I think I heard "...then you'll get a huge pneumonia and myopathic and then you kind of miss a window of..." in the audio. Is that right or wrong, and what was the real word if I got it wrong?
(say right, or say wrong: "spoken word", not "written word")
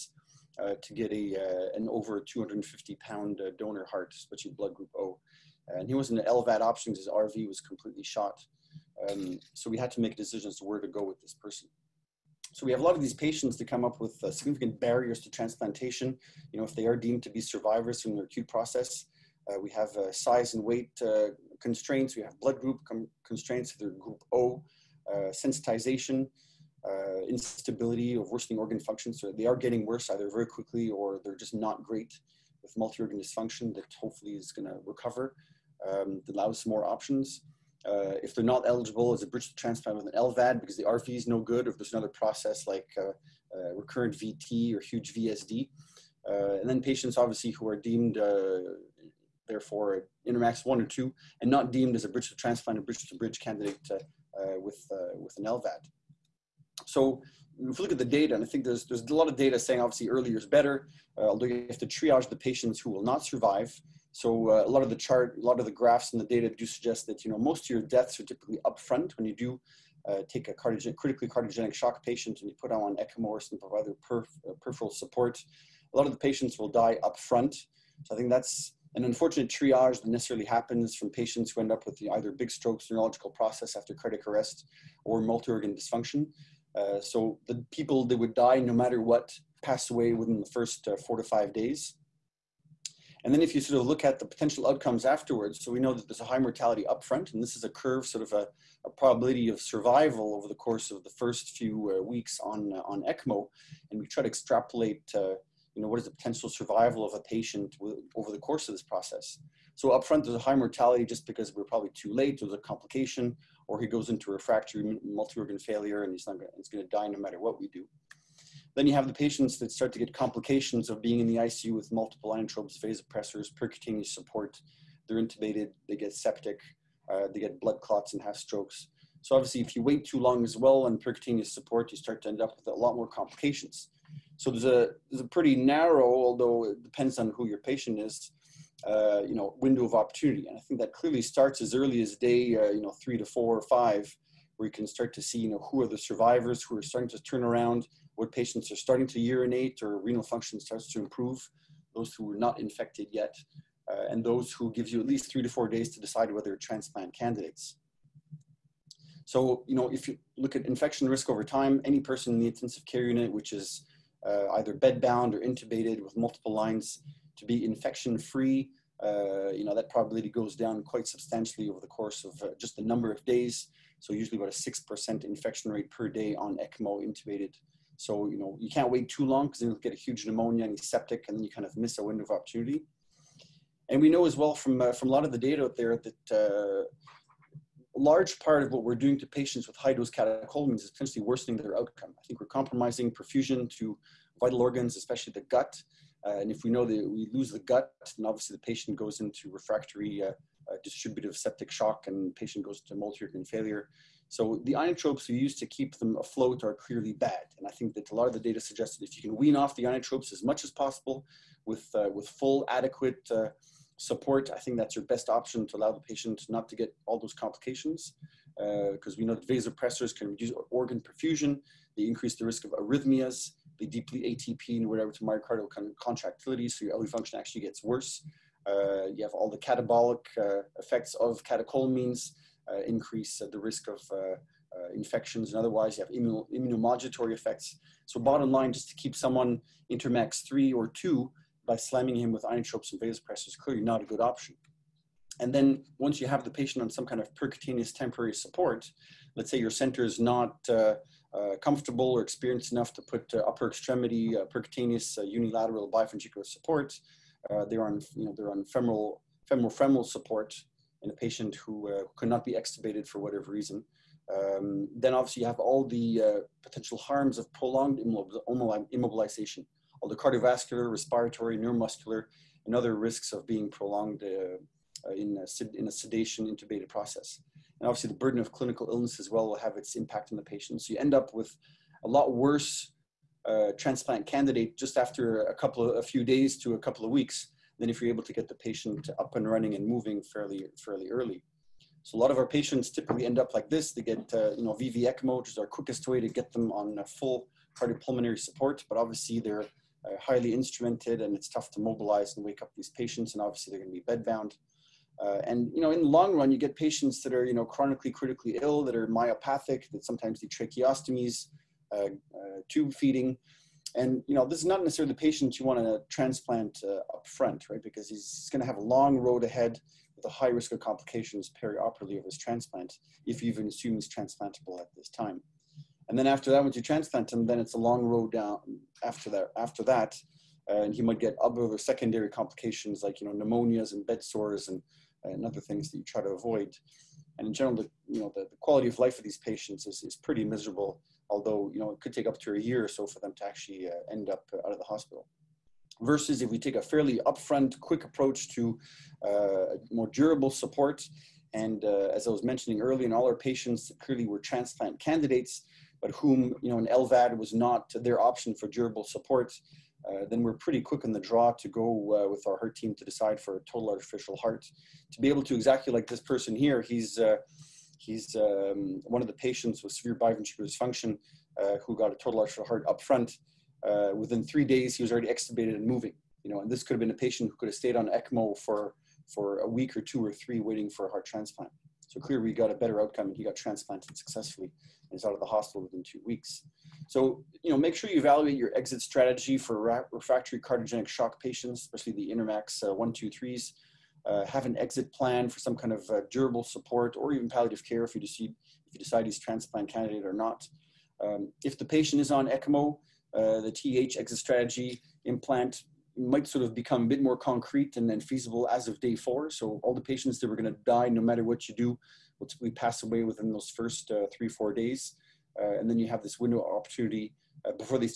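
wrong: "septic", not "myopathic".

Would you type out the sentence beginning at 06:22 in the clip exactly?
So clearly, we got a better outcome, and he got transplanted successfully is out of the hospital within two weeks.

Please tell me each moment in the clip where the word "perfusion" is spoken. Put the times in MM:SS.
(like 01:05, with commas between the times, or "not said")
03:13, 03:41.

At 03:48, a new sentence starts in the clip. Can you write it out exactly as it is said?
Uh, you have all the catabolic uh, effects of catecholamines, uh, increase uh, the risk of uh, infections and otherwise.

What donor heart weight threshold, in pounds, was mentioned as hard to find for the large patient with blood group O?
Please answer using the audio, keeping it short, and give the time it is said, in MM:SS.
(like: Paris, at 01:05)
250, at 00:02.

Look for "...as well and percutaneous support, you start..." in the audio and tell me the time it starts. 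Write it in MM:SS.
02:10.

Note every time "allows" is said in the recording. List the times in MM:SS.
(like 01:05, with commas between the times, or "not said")
00:36, 03:35.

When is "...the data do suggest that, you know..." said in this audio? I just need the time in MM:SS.
01:06.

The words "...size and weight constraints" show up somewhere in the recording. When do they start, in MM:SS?
00:20.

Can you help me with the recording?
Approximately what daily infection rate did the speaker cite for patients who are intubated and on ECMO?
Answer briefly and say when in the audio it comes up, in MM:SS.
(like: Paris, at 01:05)
6%, at 02:54.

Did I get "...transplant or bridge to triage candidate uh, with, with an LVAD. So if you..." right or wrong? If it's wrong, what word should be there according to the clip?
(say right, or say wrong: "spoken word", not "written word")
wrong: "bridge", not "triage".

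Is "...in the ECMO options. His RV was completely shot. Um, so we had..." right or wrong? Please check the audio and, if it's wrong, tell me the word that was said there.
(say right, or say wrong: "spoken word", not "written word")
wrong: "LVAD", not "ECMO".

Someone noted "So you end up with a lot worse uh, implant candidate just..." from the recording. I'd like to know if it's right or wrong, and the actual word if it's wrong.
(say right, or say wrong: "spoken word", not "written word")
wrong: "transplant", not "implant".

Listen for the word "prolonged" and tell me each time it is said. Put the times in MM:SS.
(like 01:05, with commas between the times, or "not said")
04:27, 04:33.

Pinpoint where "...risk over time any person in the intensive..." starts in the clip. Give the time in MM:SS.
02:41.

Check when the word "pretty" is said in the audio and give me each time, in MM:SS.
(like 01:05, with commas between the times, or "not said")
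02:15, 05:40, 06:00.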